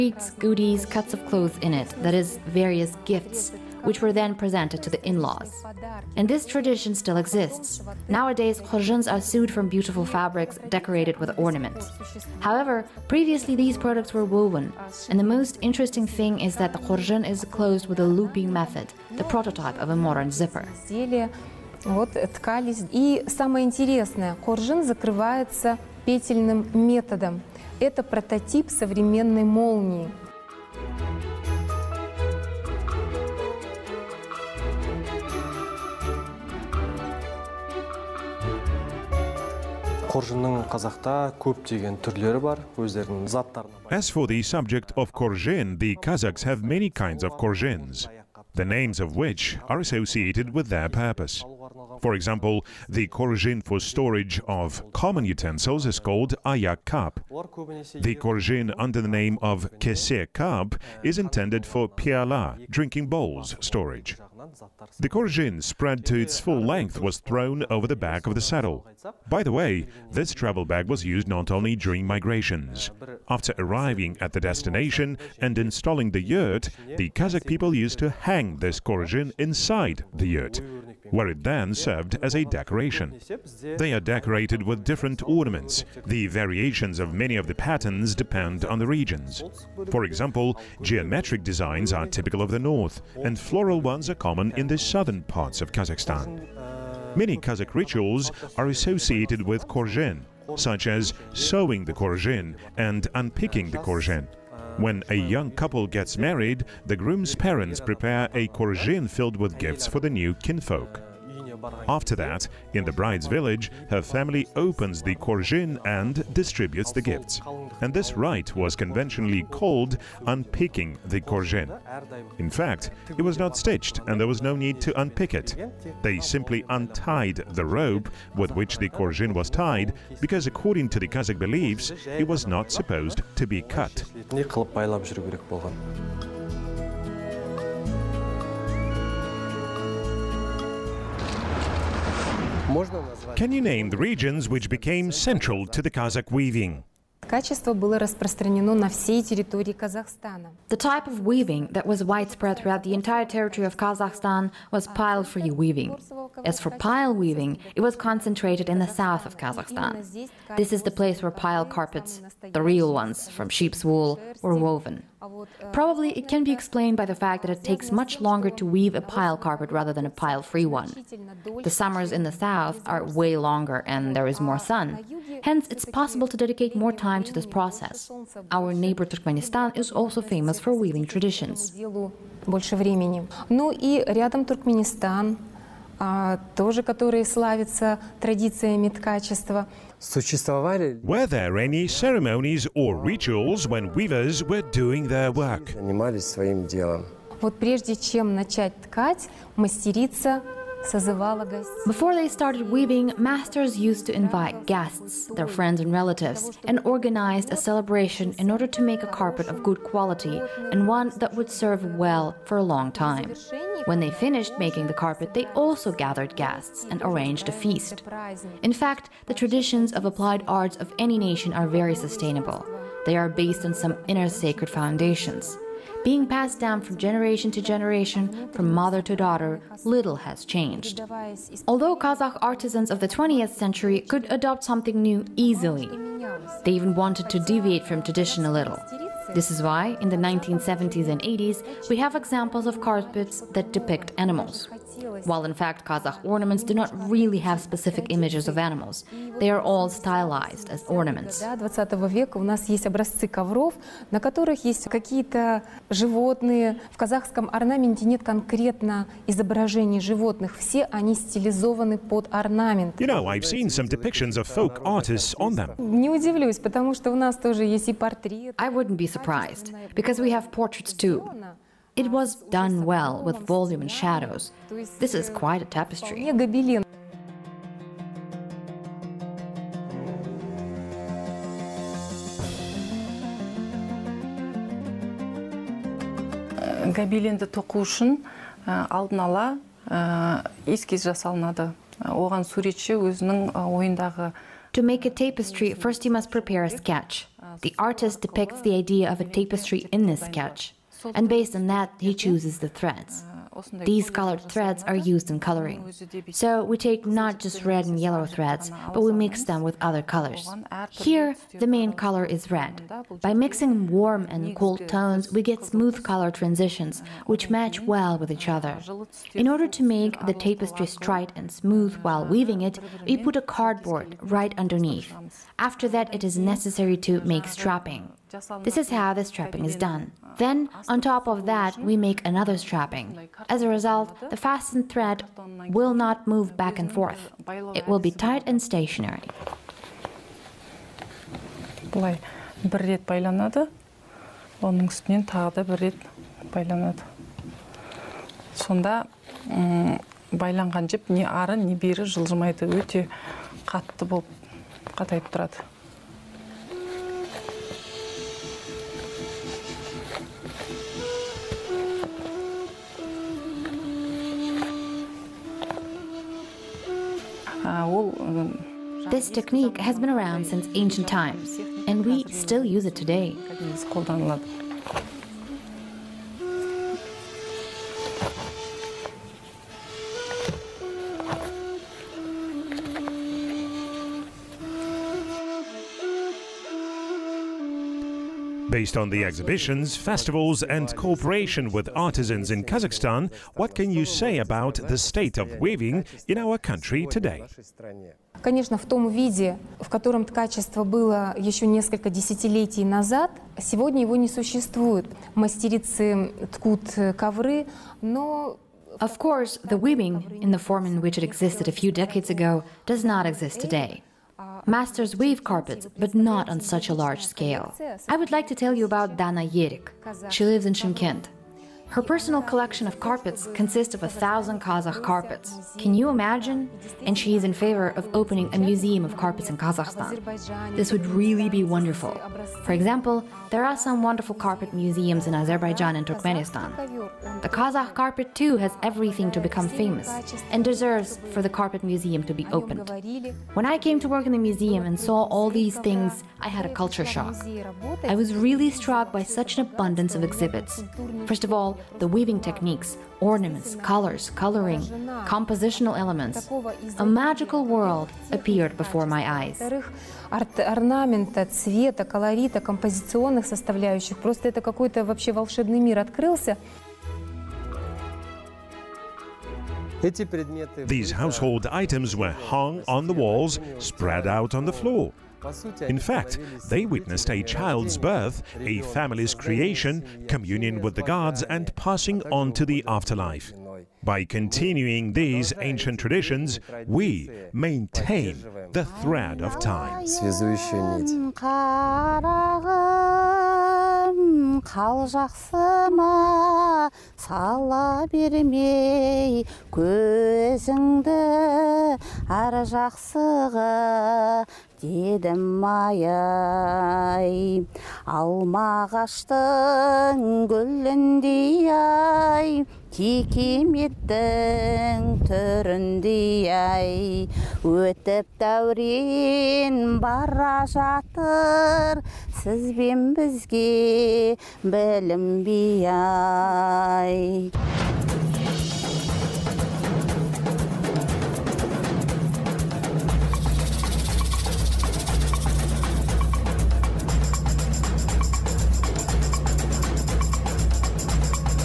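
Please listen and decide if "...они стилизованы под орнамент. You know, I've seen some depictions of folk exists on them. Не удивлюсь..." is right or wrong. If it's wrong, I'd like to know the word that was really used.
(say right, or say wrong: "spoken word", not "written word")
wrong: "artists", not "exists".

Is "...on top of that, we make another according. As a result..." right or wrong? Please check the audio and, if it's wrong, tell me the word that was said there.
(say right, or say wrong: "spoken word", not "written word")
wrong: "strapping", not "according".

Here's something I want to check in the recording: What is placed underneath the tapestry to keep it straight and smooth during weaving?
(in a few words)
cardboard.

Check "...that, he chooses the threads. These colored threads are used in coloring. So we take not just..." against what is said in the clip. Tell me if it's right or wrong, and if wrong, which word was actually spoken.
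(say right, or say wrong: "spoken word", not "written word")
right.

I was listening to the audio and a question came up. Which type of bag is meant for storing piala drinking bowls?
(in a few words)
kesir cup.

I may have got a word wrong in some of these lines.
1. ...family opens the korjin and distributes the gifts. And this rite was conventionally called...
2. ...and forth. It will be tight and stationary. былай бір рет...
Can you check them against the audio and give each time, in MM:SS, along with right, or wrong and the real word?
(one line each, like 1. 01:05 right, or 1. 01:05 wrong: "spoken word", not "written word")
1. 01:54 right
2. 05:36 right.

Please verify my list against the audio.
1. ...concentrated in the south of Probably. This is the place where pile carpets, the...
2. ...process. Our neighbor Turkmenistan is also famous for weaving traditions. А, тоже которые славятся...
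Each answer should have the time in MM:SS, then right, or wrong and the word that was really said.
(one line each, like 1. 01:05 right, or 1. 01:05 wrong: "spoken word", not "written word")
1. 02:37 wrong: "Kazakhstan", not "Probably"
2. 02:57 right.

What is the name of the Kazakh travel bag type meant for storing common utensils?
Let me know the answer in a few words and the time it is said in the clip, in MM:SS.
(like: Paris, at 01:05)
ayak cup, at 00:56.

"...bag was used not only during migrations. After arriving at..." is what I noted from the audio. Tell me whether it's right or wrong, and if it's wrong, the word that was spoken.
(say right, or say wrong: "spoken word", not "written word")
right.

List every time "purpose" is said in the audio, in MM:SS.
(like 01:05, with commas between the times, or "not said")
00:50.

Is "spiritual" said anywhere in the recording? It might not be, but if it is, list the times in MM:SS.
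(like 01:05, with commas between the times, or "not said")
not said.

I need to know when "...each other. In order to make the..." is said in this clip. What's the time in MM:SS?
05:18.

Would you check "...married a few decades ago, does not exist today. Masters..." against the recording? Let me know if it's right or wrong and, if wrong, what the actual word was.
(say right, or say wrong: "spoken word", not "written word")
wrong: "existed", not "married".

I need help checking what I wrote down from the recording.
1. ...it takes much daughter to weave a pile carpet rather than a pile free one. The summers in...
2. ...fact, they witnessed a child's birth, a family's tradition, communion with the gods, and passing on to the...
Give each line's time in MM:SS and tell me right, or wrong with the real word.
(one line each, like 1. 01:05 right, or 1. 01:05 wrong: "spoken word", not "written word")
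1. 02:47 wrong: "longer", not "daughter"
2. 07:55 wrong: "creation", not "tradition".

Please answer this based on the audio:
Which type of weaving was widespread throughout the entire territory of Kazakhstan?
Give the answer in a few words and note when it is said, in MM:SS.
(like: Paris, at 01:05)
pile-free weaving, at 02:34.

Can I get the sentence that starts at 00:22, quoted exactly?
И самое интересное, коржин закрывается петельным методом.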